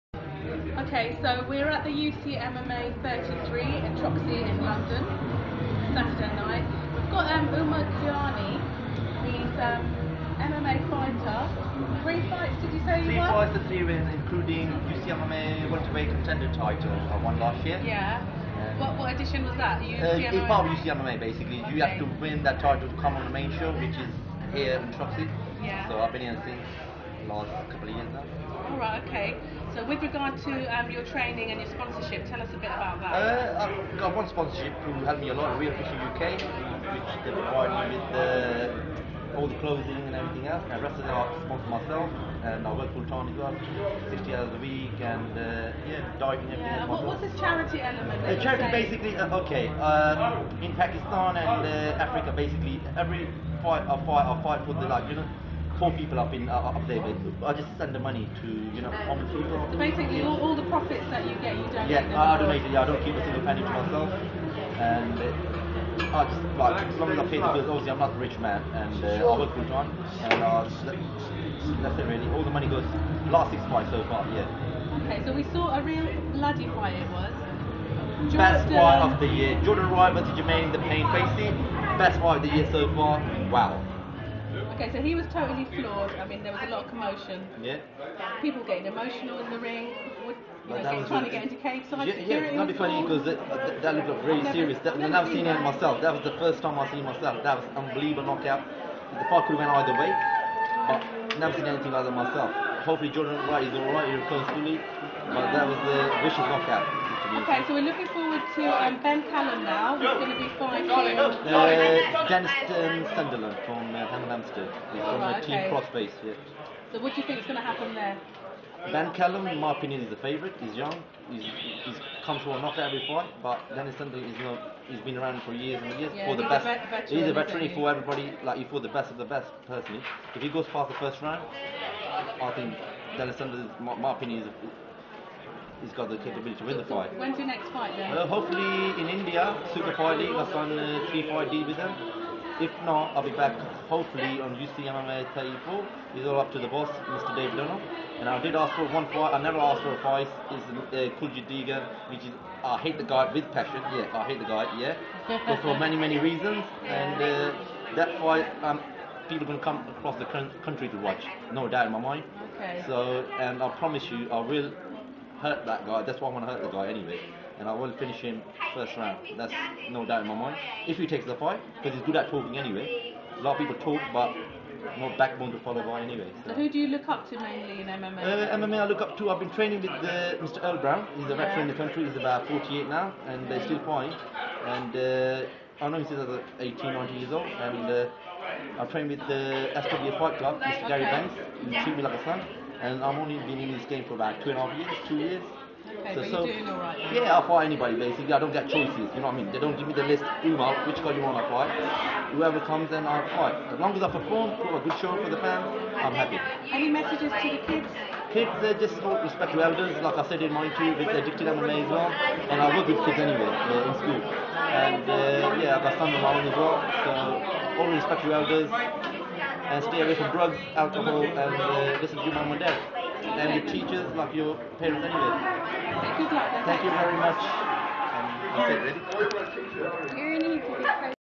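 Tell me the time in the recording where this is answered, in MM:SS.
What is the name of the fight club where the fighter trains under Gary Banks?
03:09.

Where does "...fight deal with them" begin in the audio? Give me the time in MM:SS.
02:21.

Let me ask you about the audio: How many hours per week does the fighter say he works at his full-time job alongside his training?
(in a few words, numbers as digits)
60.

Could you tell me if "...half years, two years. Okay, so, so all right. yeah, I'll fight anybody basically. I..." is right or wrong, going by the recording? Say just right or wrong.
right.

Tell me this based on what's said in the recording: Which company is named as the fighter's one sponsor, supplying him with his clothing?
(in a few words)
Real Fishing UK.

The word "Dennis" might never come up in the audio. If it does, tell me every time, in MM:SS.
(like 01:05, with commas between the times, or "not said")
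01:52, 02:03, 02:13.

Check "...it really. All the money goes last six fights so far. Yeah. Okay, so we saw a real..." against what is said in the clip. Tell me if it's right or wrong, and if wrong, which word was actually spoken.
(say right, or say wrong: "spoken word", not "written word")
right.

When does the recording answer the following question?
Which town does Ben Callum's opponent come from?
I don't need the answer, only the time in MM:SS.
01:54.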